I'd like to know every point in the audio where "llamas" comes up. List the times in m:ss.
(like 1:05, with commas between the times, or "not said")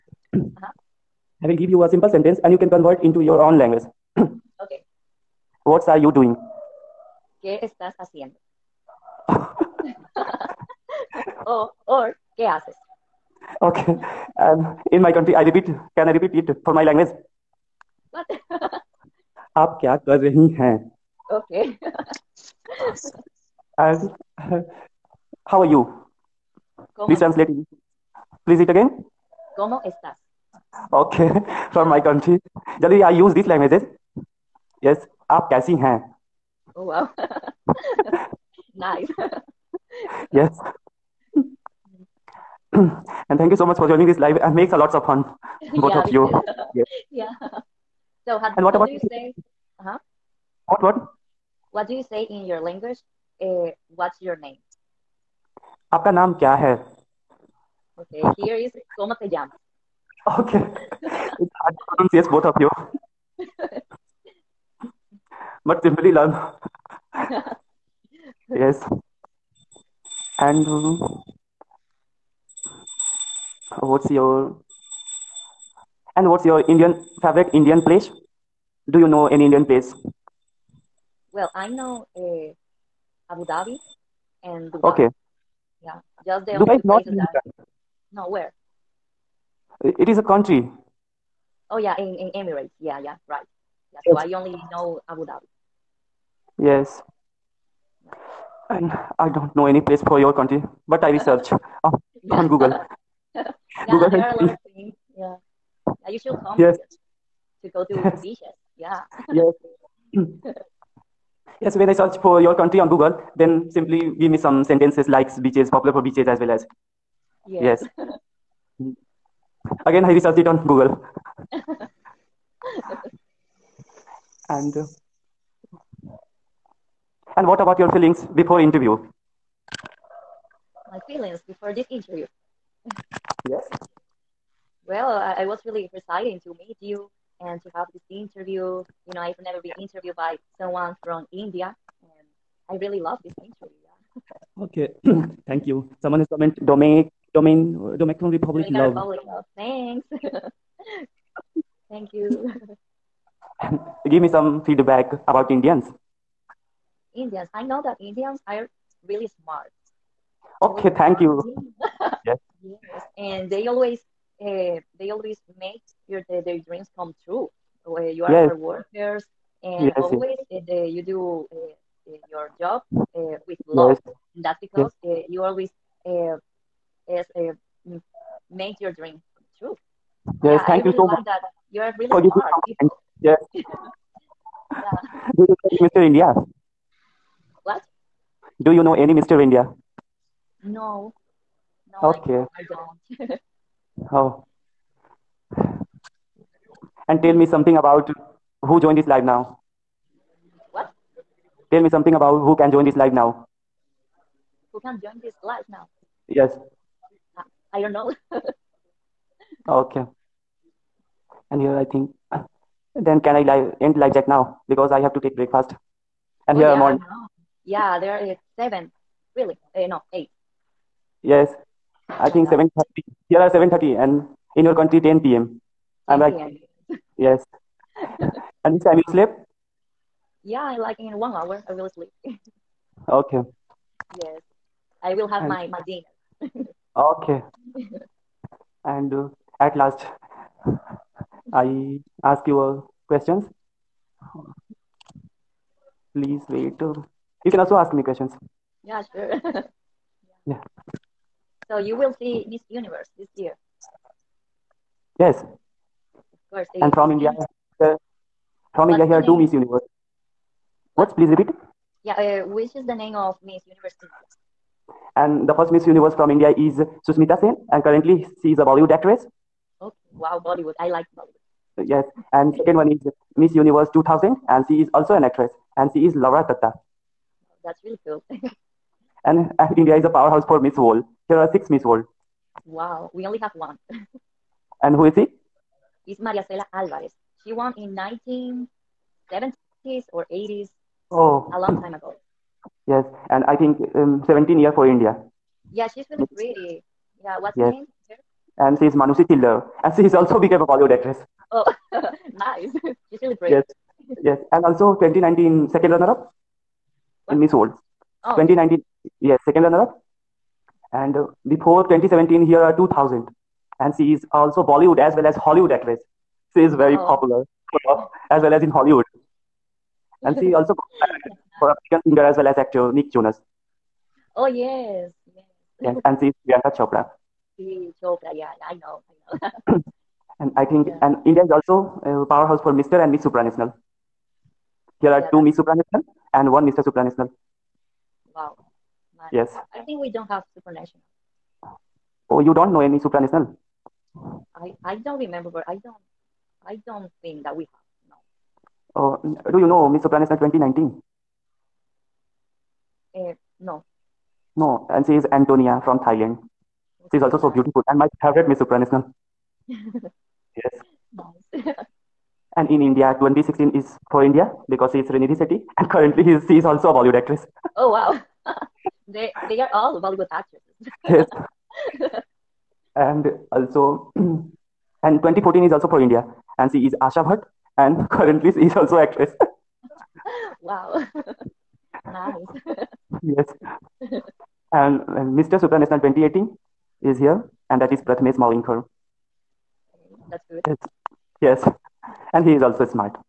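0:59.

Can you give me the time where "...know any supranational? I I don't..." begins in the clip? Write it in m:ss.
5:42.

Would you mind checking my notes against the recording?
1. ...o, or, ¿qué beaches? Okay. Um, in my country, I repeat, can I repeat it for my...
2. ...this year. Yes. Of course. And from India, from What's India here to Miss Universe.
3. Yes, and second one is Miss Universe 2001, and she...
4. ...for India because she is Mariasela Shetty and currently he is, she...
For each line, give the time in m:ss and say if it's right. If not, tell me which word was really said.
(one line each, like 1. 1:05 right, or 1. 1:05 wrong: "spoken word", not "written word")
1. 0:11 wrong: "haces", not "beaches"
2. 4:13 right
3. 4:31 wrong: "2000", not "2001"
4. 6:04 wrong: "Srinidhi", not "Mariasela".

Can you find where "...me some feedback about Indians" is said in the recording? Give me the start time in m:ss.
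2:34.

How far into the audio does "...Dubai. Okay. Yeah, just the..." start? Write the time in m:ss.
1:24.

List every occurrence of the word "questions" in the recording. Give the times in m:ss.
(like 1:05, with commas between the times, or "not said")
4:03, 4:08.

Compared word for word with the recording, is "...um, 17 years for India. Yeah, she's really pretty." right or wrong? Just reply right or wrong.
right.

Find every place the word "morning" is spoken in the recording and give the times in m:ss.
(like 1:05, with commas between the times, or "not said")
3:36.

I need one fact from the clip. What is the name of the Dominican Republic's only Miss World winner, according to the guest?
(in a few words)
Mariasela Alvarez.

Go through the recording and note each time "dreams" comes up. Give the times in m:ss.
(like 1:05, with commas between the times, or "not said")
2:46, 2:58.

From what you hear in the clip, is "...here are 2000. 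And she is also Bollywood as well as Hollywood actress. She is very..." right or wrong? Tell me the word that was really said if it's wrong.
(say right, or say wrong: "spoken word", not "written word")
right.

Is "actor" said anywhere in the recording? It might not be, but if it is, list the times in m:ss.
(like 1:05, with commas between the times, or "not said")
5:22, 6:10.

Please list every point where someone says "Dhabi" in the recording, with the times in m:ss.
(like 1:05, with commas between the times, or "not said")
1:23, 1:35.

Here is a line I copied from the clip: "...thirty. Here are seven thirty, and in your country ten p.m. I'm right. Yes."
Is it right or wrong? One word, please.
right.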